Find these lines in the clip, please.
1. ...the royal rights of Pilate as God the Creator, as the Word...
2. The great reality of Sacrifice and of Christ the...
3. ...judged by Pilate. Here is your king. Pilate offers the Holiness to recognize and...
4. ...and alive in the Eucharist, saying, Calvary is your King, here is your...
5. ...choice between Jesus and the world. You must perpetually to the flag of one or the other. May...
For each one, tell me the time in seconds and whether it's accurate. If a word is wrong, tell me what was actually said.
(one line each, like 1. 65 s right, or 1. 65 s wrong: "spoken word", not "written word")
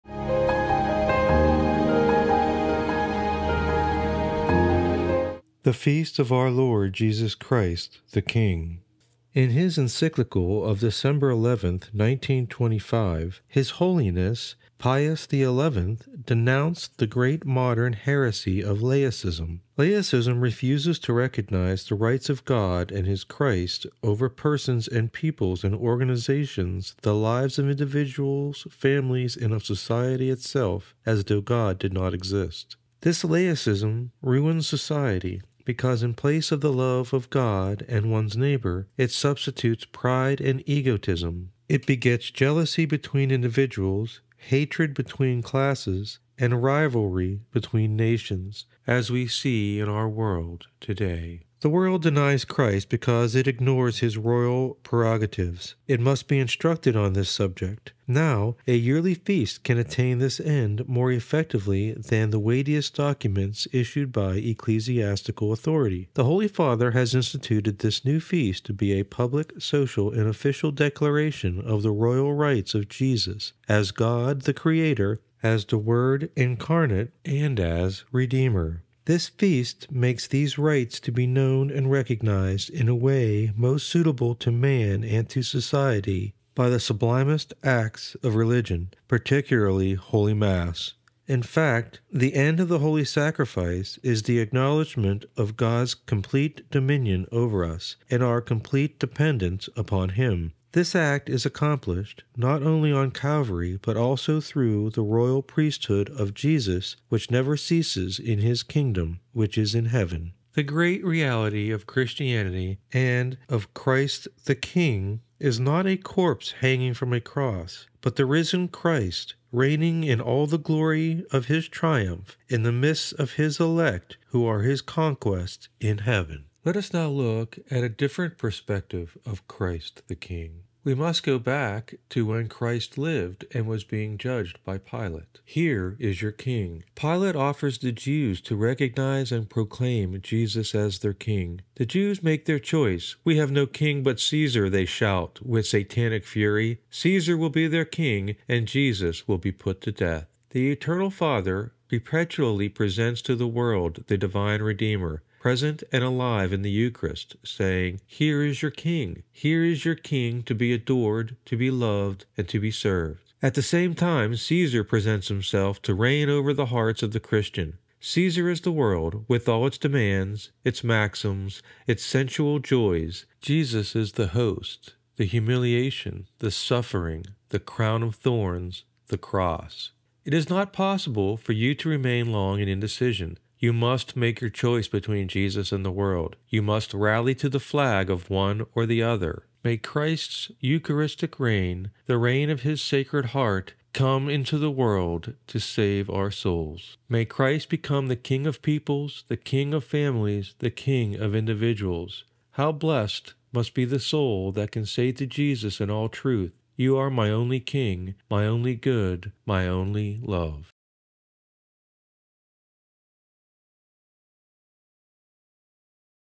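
1. 71 s wrong: "Jesus", not "Pilate"
2. 110 s wrong: "Christianity", not "Sacrifice"
3. 134 s wrong: "Jews", not "Holiness"
4. 155 s wrong: "Here", not "Calvary"
5. 184 s wrong: "rally", not "perpetually".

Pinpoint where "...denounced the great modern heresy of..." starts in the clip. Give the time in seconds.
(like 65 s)
16 s.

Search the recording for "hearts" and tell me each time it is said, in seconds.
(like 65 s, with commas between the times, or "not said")
166 s, 193 s.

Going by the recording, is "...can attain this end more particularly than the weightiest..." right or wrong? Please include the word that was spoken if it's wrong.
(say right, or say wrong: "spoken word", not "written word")
wrong: "effectively", not "particularly".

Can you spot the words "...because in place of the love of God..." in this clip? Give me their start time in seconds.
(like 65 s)
35 s.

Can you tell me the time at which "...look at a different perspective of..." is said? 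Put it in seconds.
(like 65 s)
127 s.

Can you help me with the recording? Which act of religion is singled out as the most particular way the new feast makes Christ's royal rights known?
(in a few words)
Holy Mass.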